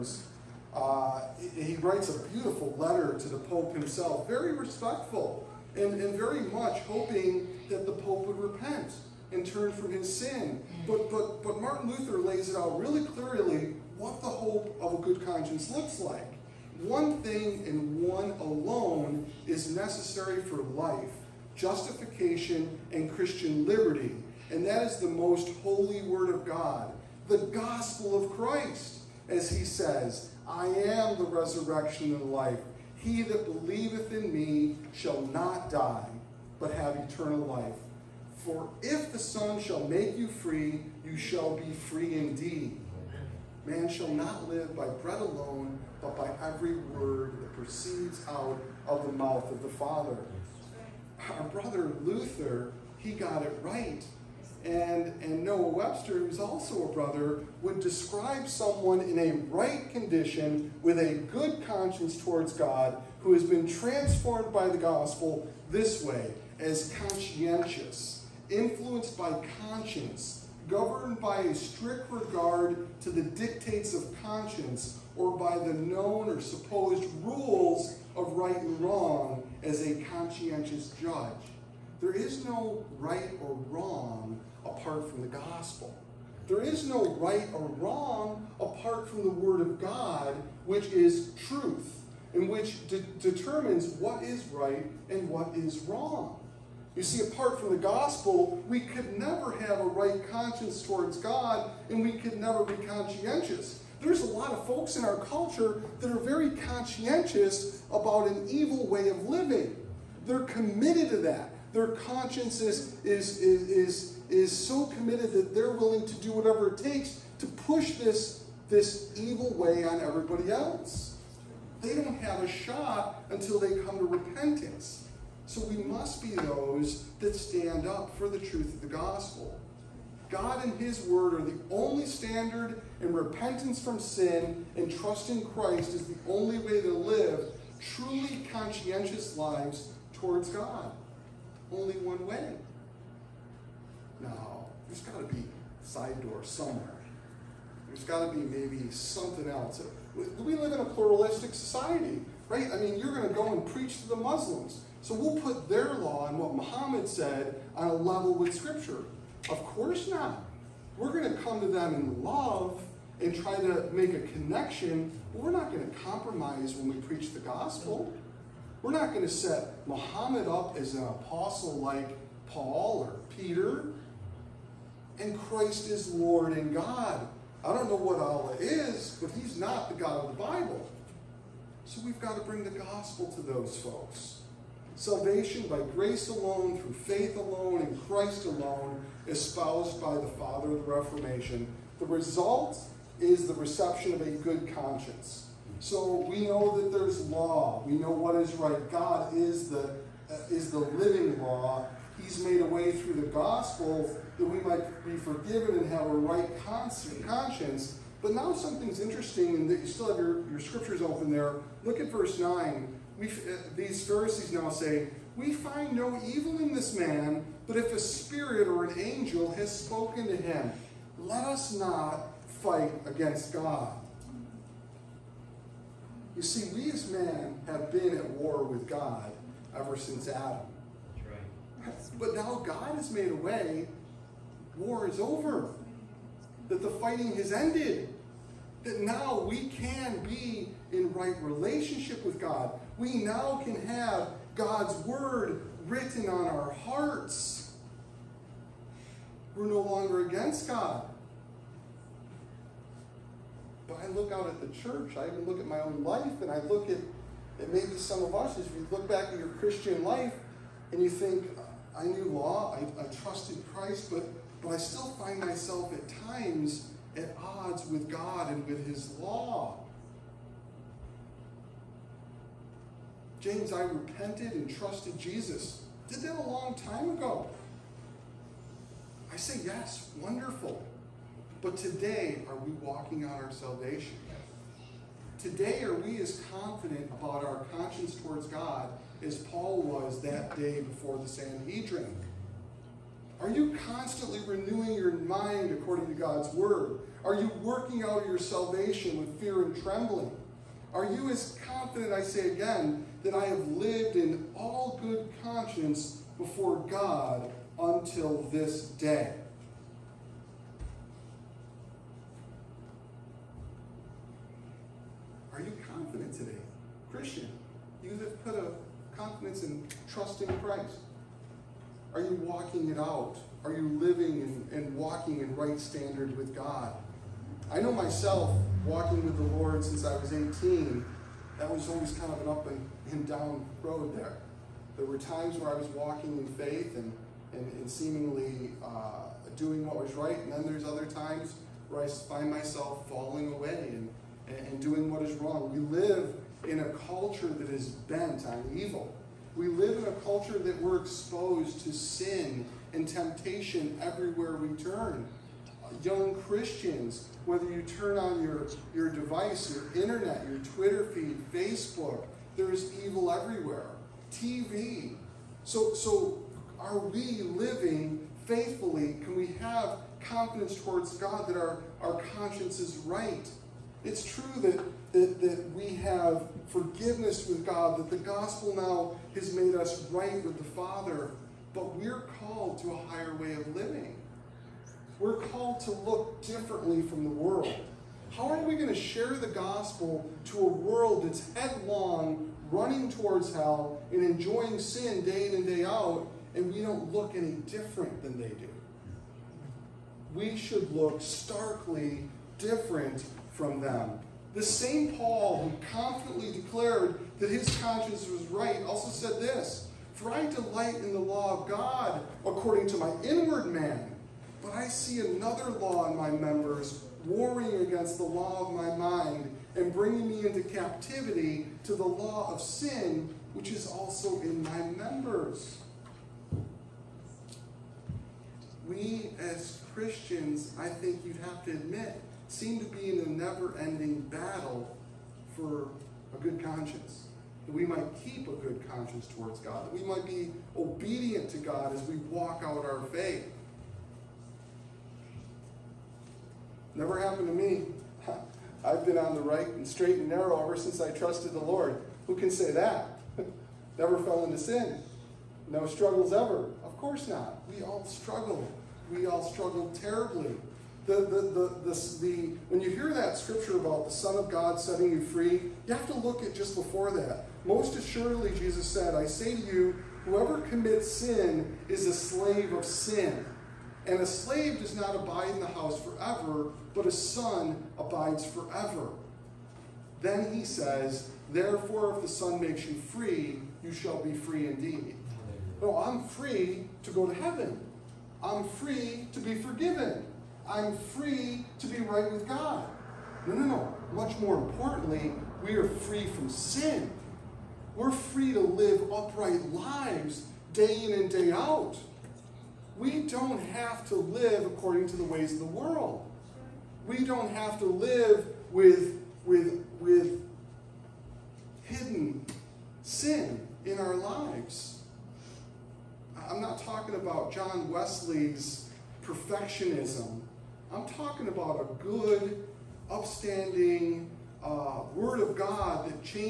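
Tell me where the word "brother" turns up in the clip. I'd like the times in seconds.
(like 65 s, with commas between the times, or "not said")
51 s, 56 s.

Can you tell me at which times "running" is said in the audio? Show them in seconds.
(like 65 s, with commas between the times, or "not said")
392 s.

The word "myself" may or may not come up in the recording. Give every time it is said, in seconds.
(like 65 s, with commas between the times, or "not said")
265 s, 327 s, 342 s.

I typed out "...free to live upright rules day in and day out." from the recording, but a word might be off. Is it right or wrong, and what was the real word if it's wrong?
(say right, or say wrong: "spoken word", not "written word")
wrong: "lives", not "rules".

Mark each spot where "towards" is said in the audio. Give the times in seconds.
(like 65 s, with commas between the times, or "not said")
62 s, 100 s, 140 s, 288 s, 370 s, 393 s, 439 s.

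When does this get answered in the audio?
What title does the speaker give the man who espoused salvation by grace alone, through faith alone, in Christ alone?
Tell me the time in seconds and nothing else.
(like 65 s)
190 s.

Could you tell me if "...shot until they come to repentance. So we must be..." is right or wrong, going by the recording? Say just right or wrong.
right.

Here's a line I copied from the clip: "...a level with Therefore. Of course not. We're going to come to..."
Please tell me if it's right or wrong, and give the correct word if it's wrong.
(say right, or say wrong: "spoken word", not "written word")
wrong: "Scripture", not "Therefore".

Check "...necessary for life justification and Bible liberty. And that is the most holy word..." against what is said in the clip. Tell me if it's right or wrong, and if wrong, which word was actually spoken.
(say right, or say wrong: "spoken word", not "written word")
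wrong: "Christian", not "Bible".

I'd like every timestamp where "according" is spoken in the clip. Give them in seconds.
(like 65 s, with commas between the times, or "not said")
295 s, 412 s, 504 s.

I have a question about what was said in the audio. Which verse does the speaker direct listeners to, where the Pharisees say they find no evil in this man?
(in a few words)
Verse 9.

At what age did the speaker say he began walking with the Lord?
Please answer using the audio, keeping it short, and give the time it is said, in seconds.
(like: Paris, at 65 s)
18, at 330 s.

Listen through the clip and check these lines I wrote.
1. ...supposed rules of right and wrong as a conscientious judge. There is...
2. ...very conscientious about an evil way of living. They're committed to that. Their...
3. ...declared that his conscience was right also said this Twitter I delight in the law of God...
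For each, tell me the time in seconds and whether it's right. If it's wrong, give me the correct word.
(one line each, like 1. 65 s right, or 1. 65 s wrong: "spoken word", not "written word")
1. 76 s right
2. 106 s right
3. 406 s wrong: "For", not "Twitter".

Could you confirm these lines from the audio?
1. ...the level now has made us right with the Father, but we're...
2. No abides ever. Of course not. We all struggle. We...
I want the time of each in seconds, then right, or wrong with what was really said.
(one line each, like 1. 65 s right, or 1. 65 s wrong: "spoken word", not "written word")
1. 378 s wrong: "gospel", not "level"
2. 455 s wrong: "struggles", not "abides".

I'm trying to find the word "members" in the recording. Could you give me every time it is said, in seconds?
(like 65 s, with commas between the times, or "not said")
416 s, 425 s.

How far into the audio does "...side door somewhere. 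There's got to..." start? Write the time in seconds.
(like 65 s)
145 s.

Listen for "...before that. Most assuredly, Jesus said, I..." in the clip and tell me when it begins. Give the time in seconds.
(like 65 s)
466 s.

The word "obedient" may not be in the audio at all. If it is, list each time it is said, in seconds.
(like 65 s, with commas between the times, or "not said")
440 s.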